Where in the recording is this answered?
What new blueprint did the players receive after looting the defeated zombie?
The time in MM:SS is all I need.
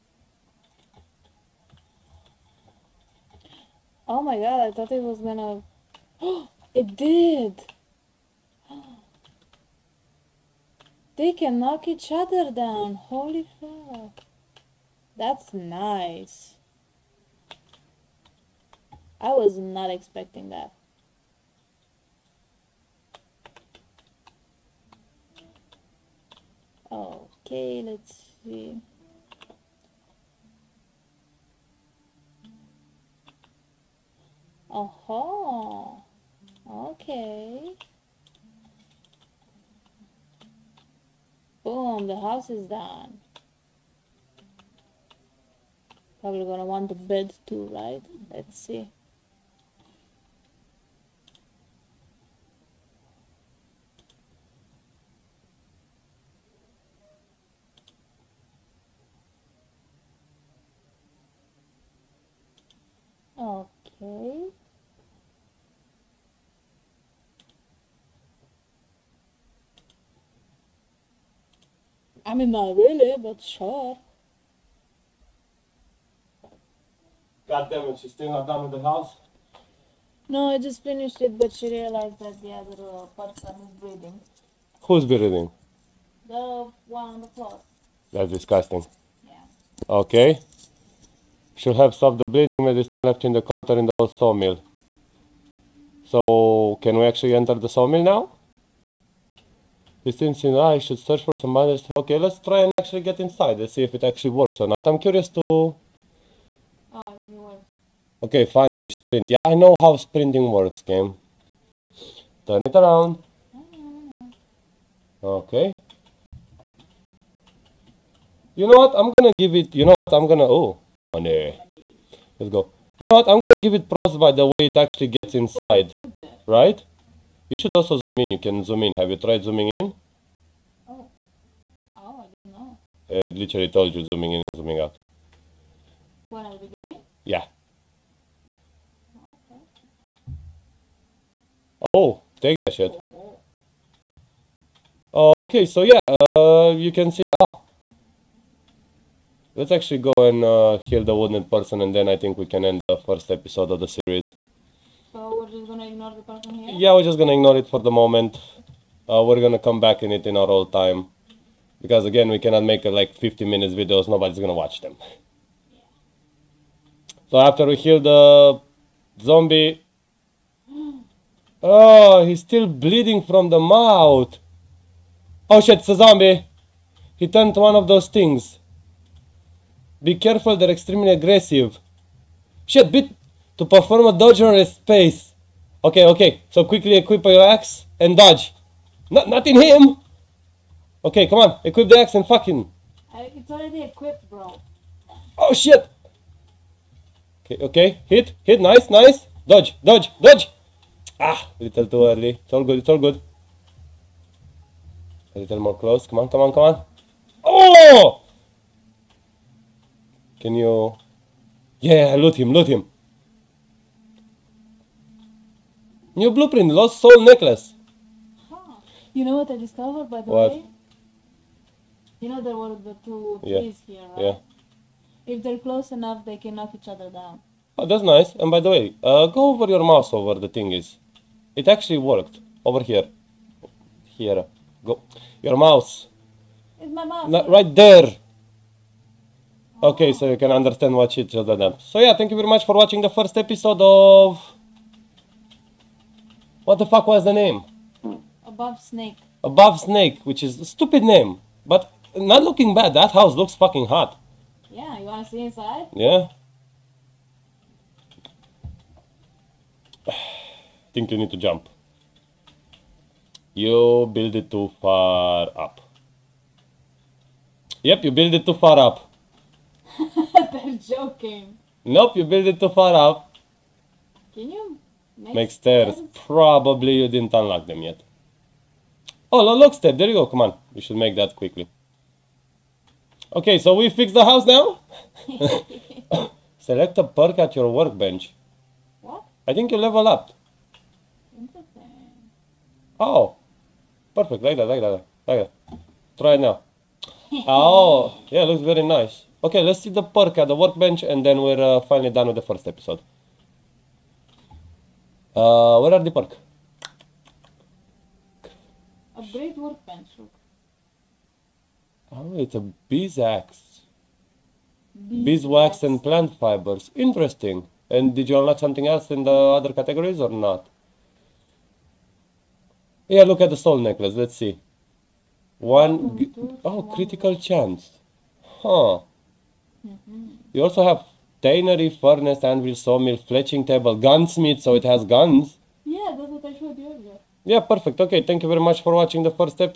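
03:36.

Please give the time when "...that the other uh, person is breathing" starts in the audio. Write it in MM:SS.
01:22.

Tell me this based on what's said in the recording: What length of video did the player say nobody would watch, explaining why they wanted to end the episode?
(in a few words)
50 minutes.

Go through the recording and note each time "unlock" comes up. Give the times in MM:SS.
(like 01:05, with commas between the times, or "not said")
04:37, 05:18.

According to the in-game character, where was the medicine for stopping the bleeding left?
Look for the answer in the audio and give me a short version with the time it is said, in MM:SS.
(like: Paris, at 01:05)
the old sawmill, at 01:33.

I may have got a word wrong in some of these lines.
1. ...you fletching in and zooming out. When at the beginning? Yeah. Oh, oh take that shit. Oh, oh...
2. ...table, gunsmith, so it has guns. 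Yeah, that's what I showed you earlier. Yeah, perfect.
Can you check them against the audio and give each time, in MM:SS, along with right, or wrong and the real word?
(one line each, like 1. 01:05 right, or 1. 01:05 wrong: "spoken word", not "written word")
1. 02:13 wrong: "zooming", not "fletching"
2. 05:33 right.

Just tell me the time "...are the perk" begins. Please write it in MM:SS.
05:05.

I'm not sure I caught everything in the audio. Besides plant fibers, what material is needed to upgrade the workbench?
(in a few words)
Beeswax.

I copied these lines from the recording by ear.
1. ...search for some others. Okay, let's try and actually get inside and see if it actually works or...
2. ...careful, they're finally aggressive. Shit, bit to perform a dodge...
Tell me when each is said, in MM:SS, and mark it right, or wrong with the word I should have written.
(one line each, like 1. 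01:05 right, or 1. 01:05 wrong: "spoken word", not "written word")
1. 01:40 right
2. 03:00 wrong: "extremely", not "finally".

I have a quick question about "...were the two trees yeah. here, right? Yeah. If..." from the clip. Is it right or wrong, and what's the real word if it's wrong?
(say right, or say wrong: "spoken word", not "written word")
right.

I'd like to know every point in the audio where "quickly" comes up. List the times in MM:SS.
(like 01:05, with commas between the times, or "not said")
03:06, 04:41.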